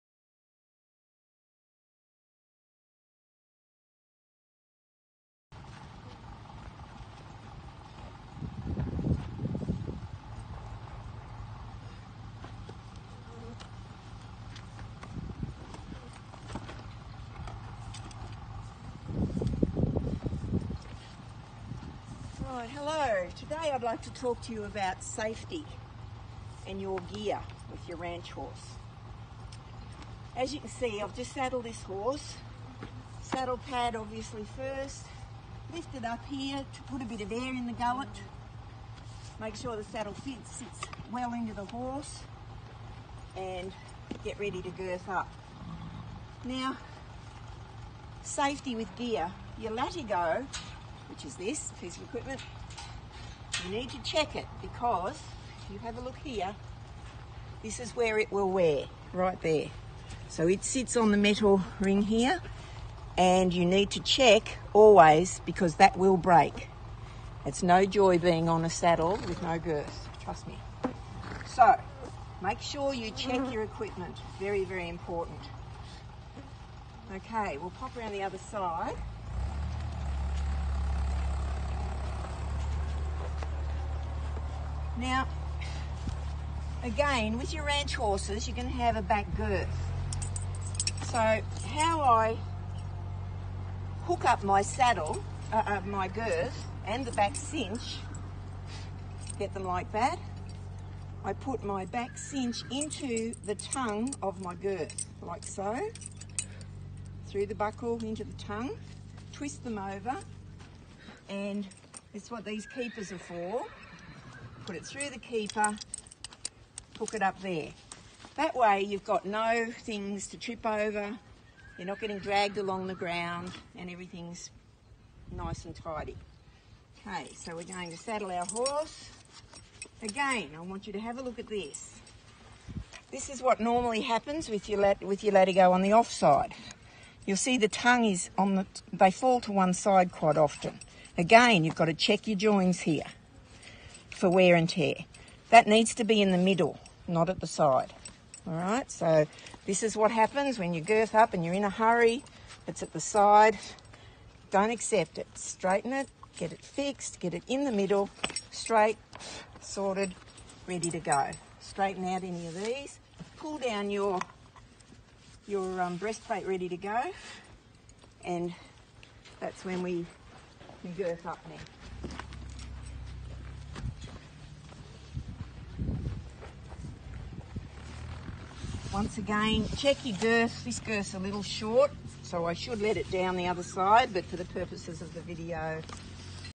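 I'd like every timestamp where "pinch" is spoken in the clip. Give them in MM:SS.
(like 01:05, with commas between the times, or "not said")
not said.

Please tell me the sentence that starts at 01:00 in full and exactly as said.
So it sits on the metal ring here and you need to check always because that will break.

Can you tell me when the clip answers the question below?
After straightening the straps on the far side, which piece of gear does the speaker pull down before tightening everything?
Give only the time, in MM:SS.
02:45.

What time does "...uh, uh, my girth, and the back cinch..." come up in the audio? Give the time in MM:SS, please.
01:35.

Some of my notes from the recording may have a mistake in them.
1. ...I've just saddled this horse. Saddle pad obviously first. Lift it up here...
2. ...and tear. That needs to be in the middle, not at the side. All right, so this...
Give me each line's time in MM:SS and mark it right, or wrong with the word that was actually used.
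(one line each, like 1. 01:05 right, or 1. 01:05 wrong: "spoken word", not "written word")
1. 00:31 right
2. 02:24 right.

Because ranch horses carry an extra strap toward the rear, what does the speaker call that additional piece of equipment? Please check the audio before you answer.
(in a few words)
Back girth.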